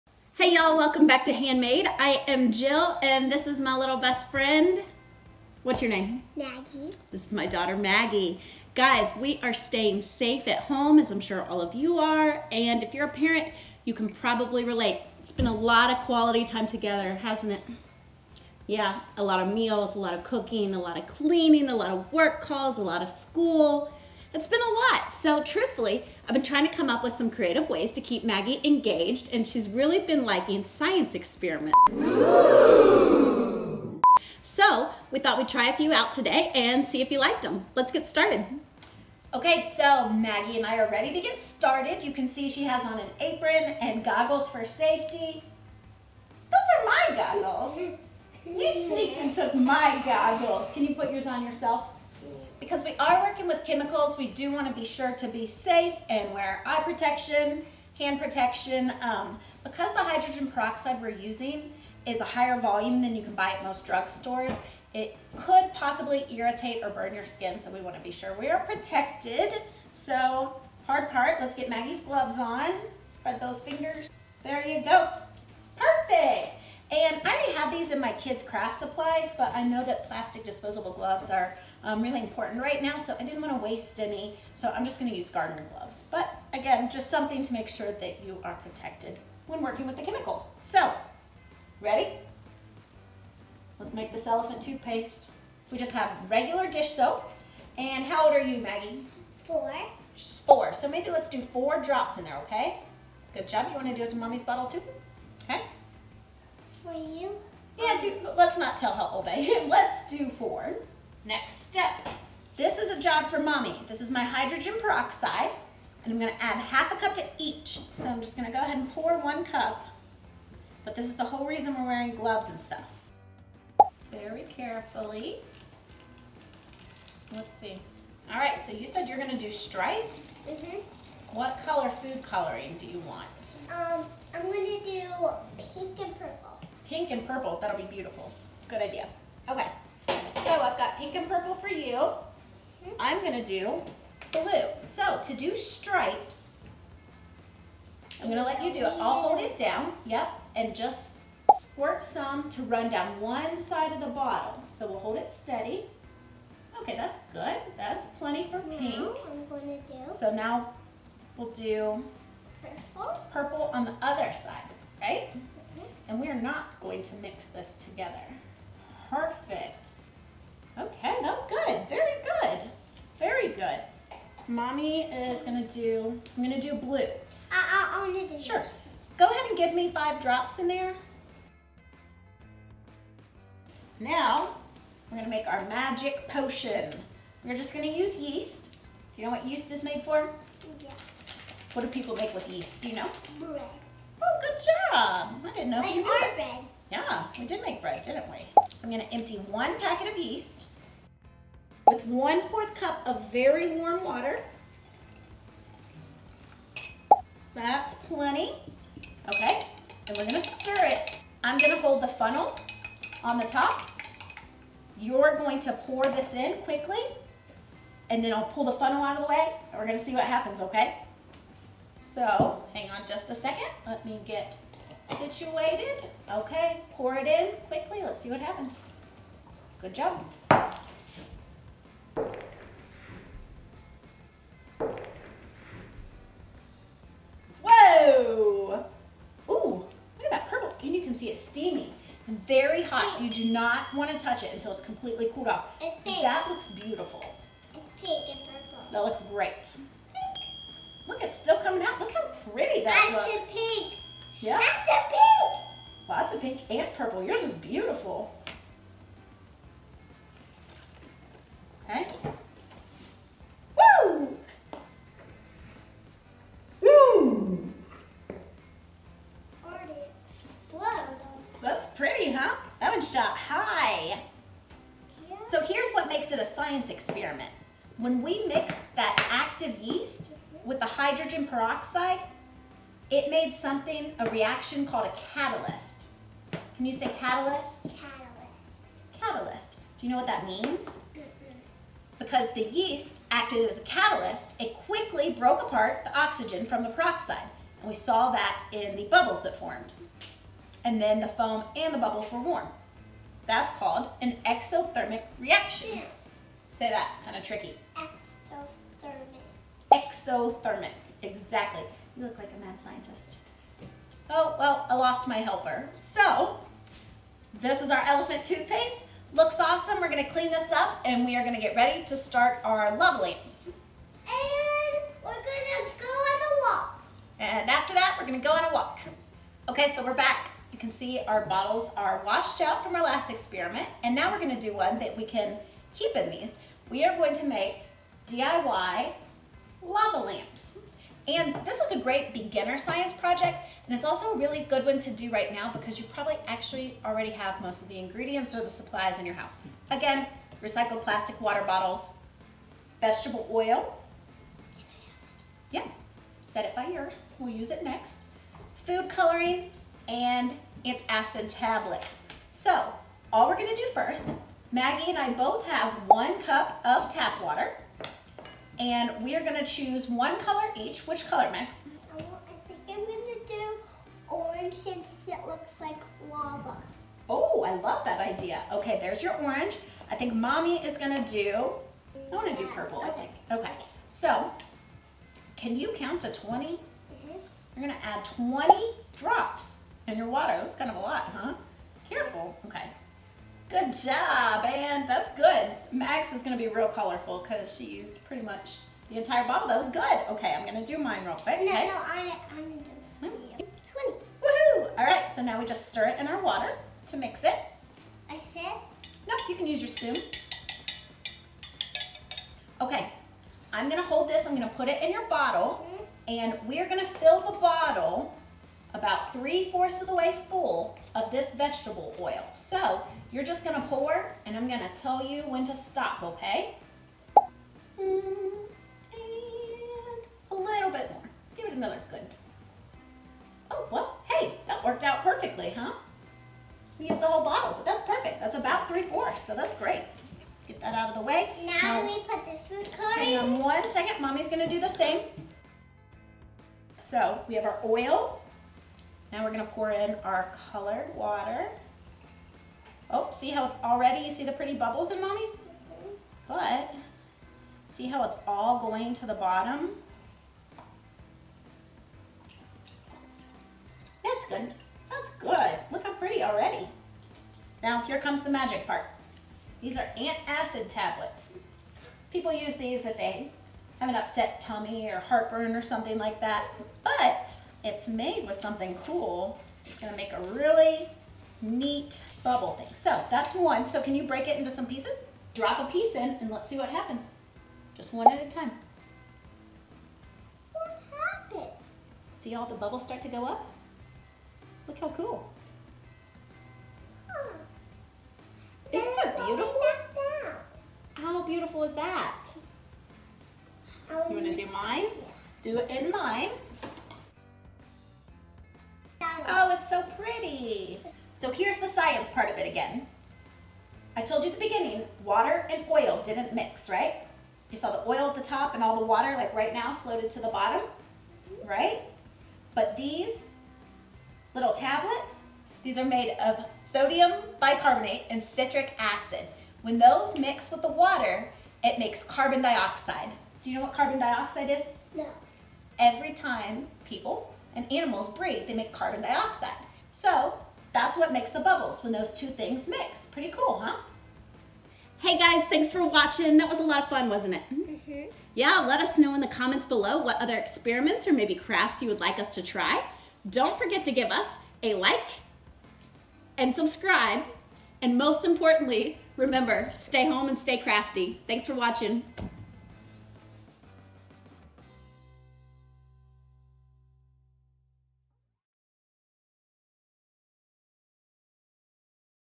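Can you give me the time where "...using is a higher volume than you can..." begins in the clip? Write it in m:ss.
1:01.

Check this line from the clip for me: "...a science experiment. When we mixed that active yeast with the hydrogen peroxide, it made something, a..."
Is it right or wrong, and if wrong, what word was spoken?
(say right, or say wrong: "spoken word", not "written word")
right.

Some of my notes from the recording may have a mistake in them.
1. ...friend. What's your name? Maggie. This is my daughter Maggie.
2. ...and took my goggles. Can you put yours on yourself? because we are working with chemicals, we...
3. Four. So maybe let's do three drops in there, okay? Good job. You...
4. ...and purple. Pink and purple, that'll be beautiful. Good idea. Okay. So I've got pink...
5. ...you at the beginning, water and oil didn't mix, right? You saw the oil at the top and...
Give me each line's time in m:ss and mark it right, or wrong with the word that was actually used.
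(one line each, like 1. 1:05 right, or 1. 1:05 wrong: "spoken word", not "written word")
1. 0:04 right
2. 0:49 right
3. 1:40 wrong: "four", not "three"
4. 2:15 right
5. 8:34 right.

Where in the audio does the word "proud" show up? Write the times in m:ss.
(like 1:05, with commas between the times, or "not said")
not said.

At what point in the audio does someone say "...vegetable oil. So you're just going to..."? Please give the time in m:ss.
7:01.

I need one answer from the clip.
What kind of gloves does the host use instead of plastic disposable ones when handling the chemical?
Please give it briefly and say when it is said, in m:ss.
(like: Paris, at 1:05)
Gardener gloves, at 1:25.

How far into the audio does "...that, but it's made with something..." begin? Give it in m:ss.
7:56.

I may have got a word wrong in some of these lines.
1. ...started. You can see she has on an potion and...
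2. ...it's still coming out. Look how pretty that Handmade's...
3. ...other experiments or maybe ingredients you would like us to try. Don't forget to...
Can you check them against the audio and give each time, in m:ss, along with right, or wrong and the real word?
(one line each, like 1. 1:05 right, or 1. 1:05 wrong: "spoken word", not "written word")
1. 0:41 wrong: "apron", not "potion"
2. 4:11 wrong: "That", not "Handmade"
3. 9:10 wrong: "crafts", not "ingredients".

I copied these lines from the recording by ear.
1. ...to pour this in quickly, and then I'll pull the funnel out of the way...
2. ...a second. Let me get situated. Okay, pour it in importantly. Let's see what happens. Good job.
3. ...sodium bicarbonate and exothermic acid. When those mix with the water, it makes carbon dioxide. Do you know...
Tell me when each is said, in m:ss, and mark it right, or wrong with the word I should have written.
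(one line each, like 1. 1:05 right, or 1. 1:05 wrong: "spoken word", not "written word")
1. 3:35 right
2. 3:43 wrong: "quickly", not "importantly"
3. 8:46 wrong: "citric", not "exothermic".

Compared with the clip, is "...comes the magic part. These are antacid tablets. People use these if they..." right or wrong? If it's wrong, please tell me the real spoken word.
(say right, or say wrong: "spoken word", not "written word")
right.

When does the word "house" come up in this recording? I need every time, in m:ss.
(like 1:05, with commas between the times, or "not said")
5:49.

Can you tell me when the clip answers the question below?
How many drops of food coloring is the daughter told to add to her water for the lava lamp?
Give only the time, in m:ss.
6:28.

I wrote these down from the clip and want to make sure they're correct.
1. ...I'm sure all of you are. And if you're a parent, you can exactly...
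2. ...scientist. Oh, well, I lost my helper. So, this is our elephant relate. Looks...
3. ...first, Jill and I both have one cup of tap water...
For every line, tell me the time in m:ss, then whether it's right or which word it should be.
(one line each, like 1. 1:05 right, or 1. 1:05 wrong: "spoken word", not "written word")
1. 0:11 wrong: "probably", not "exactly"
2. 5:12 wrong: "toothpaste", not "relate"
3. 6:03 wrong: "Maggie", not "Jill".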